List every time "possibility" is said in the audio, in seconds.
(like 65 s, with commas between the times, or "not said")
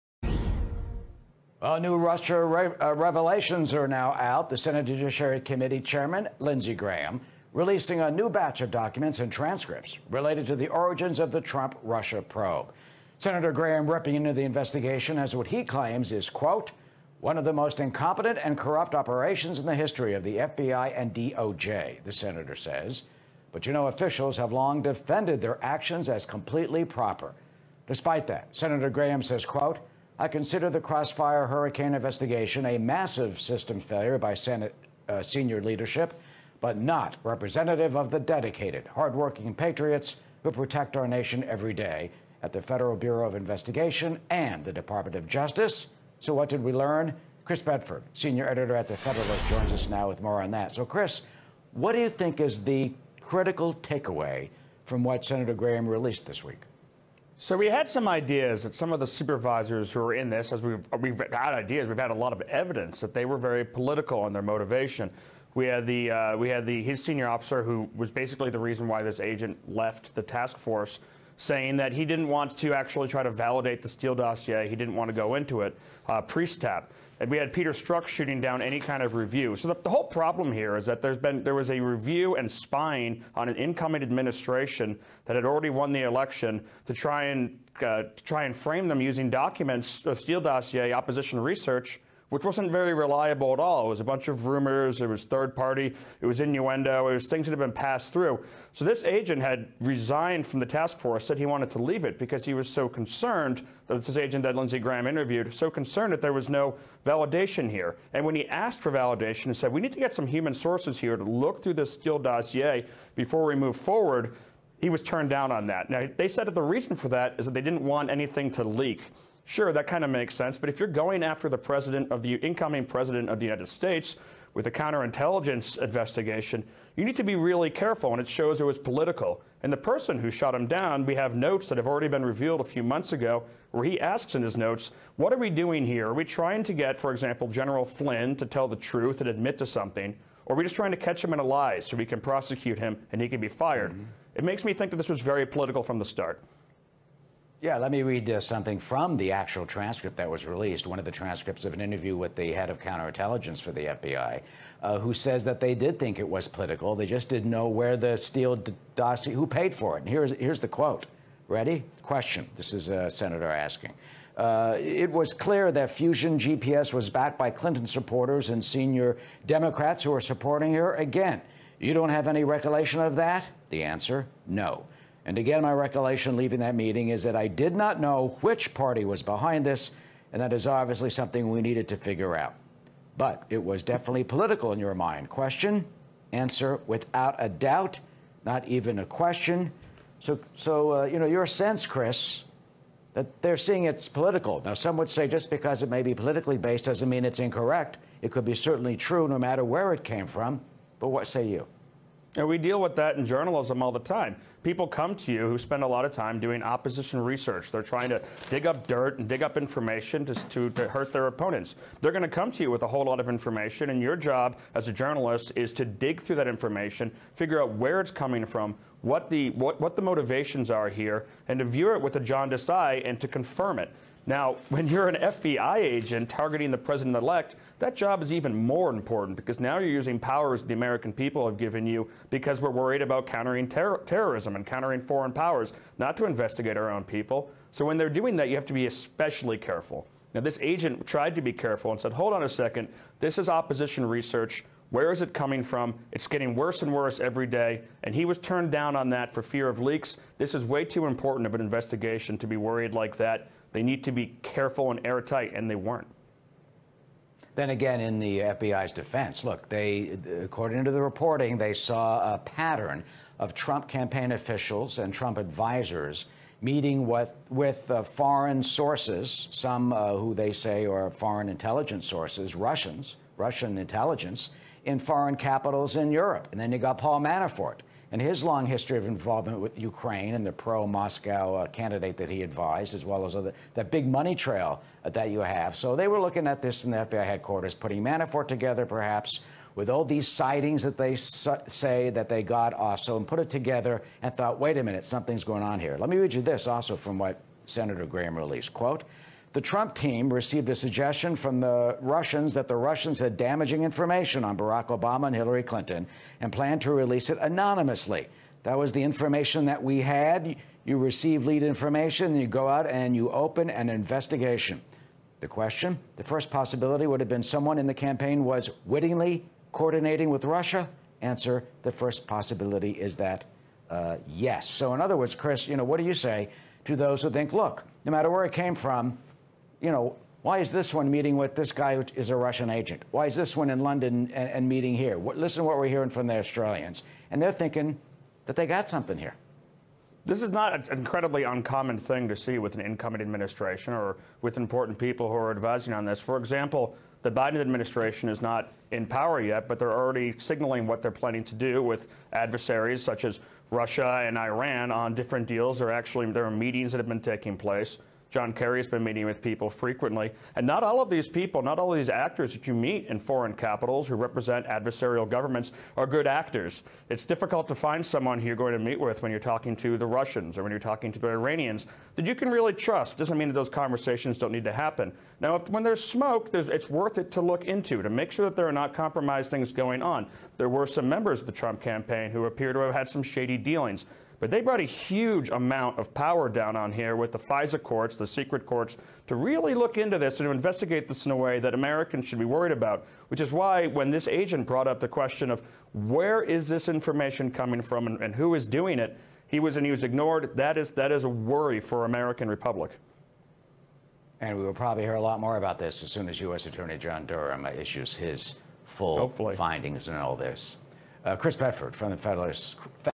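316 s, 322 s.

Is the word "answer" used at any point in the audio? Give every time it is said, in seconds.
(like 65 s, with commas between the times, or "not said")
173 s, 186 s, 321 s.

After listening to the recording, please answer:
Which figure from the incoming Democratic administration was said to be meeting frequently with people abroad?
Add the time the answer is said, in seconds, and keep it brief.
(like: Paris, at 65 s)
John Kerry, at 358 s.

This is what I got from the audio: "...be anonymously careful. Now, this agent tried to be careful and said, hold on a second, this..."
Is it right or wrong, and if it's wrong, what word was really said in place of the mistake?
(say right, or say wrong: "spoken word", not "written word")
wrong: "especially", not "anonymously".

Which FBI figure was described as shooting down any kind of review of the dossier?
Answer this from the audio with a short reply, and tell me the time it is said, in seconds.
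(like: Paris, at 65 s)
Peter Strzok, at 77 s.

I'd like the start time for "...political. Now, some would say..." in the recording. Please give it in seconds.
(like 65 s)
194 s.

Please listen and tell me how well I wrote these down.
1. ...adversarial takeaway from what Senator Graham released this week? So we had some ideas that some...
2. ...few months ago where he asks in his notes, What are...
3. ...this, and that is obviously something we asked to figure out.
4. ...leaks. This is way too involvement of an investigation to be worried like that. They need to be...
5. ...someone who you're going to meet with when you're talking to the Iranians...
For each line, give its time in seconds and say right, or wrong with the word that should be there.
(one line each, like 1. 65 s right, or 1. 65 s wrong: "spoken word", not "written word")
1. 53 s wrong: "critical", not "adversarial"
2. 132 s right
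3. 179 s wrong: "needed", not "asked"
4. 249 s wrong: "important", not "involvement"
5. 368 s wrong: "Russians", not "Iranians".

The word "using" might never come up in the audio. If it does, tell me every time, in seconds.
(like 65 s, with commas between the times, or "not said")
89 s, 229 s.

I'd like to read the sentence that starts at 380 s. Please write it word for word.
There were some members of the Trump campaign who appear to have had some shady dealings.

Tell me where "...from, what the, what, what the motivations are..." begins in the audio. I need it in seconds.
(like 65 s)
218 s.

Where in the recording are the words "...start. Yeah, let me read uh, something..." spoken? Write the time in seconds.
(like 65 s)
146 s.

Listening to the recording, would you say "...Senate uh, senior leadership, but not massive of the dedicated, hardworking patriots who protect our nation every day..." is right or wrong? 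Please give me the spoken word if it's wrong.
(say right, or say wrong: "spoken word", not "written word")
wrong: "representative", not "massive".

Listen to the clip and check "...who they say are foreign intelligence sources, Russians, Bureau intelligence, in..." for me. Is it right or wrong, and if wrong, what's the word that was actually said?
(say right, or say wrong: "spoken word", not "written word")
wrong: "Russian", not "Bureau".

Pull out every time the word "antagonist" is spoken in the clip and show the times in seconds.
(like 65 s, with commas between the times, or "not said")
not said.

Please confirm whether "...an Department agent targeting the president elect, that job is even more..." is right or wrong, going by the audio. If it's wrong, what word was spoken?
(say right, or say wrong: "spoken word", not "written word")
wrong: "FBI", not "Department".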